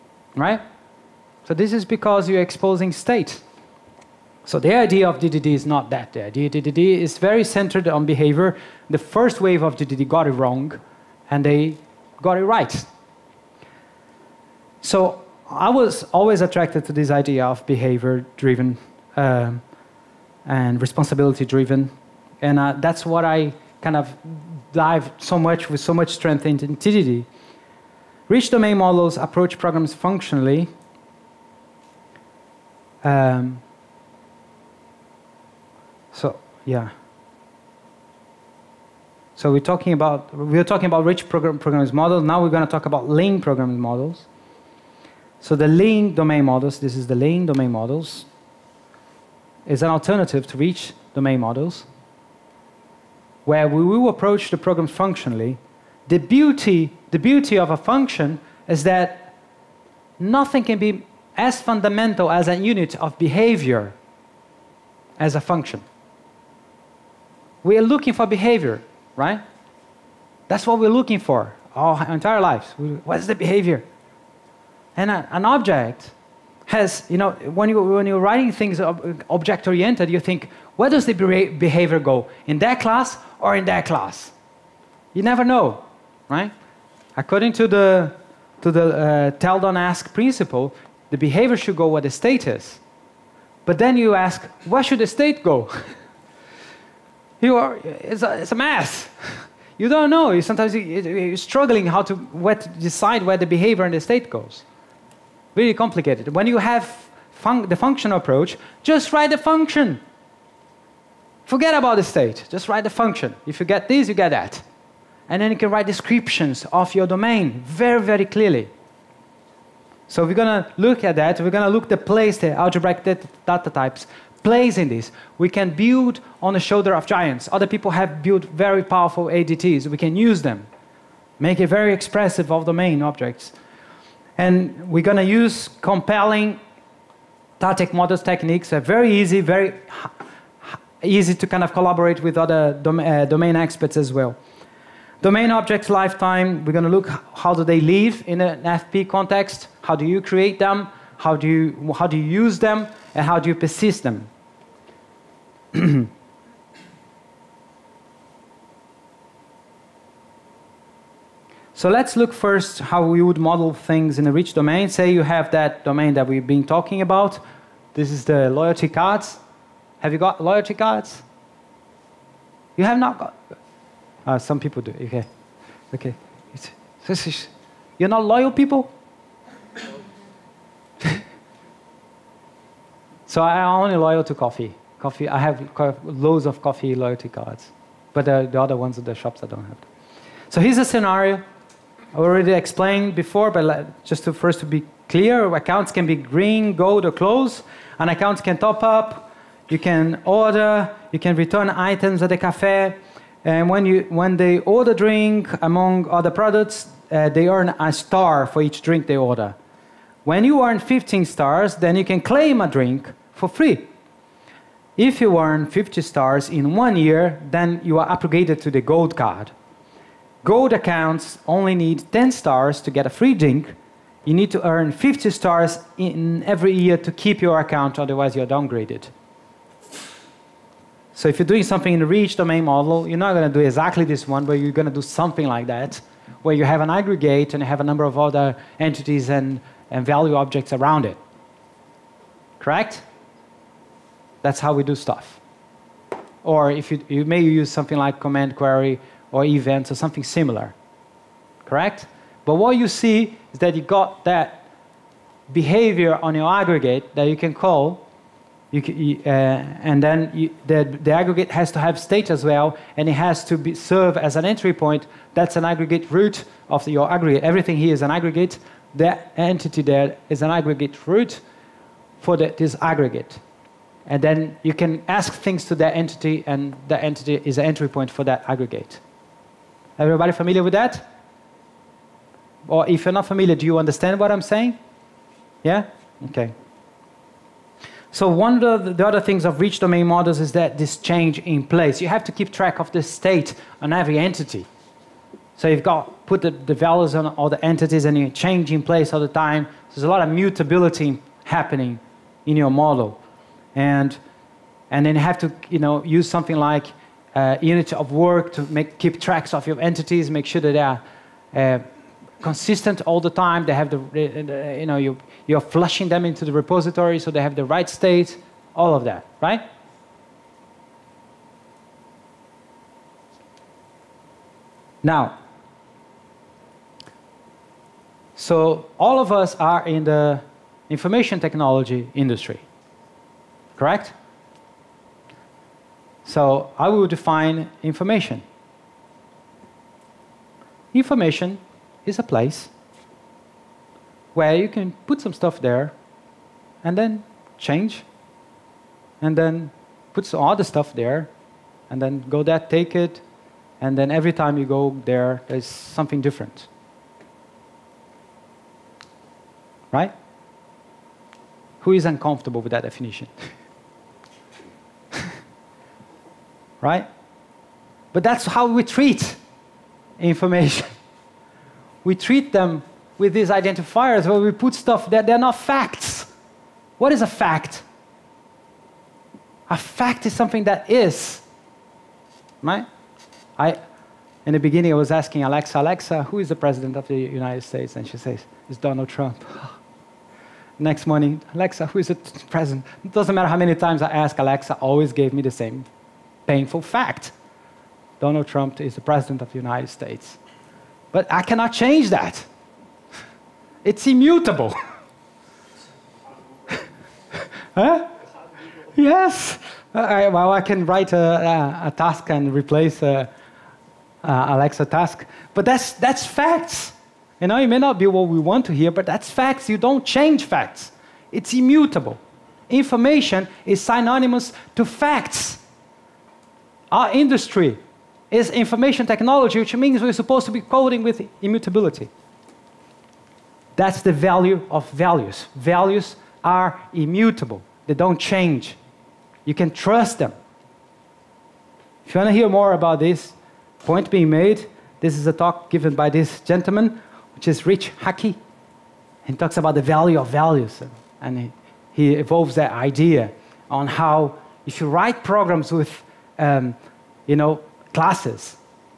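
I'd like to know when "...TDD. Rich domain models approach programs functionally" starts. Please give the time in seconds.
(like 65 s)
26 s.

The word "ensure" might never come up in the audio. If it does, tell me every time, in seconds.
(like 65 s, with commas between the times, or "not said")
not said.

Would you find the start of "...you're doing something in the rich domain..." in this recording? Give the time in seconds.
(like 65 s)
231 s.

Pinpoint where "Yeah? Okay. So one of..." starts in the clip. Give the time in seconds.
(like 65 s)
285 s.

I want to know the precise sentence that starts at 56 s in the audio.
The beauty the beauty of a function is that nothing can be as fundamental as a unit of behavior as a function.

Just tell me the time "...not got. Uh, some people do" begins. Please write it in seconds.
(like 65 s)
172 s.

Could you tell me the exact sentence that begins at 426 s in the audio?
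Our industry is information technology, which means we're supposed to be coding with immutability.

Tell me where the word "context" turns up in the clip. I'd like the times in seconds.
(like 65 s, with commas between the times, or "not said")
149 s.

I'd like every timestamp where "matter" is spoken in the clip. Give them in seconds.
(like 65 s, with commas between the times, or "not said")
393 s.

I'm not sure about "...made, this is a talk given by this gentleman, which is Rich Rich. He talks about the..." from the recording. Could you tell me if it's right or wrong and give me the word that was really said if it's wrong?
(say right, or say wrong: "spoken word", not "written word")
wrong: "Hickey", not "Rich".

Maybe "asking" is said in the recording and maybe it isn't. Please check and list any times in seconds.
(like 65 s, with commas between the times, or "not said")
385 s.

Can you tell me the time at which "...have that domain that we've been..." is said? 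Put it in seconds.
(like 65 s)
165 s.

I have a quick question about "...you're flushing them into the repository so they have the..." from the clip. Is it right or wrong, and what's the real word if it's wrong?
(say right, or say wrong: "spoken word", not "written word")
right.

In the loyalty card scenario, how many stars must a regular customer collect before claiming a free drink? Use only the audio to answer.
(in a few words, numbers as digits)
15.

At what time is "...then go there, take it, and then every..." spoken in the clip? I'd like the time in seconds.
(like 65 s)
352 s.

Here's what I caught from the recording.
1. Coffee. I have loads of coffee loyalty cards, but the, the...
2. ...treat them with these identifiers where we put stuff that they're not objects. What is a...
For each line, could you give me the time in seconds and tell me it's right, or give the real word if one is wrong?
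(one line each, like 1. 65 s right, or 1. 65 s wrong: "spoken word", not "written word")
1. 184 s right
2. 372 s wrong: "facts", not "objects".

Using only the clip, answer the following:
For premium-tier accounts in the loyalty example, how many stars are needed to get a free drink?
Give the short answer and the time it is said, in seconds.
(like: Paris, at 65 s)
10, at 222 s.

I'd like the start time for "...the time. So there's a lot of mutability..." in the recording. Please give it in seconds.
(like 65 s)
299 s.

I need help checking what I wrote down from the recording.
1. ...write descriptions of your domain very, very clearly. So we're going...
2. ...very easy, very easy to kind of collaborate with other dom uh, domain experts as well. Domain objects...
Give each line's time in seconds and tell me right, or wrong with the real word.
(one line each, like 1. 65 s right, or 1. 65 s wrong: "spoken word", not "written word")
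1. 115 s right
2. 138 s right.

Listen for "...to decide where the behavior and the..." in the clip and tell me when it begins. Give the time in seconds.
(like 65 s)
102 s.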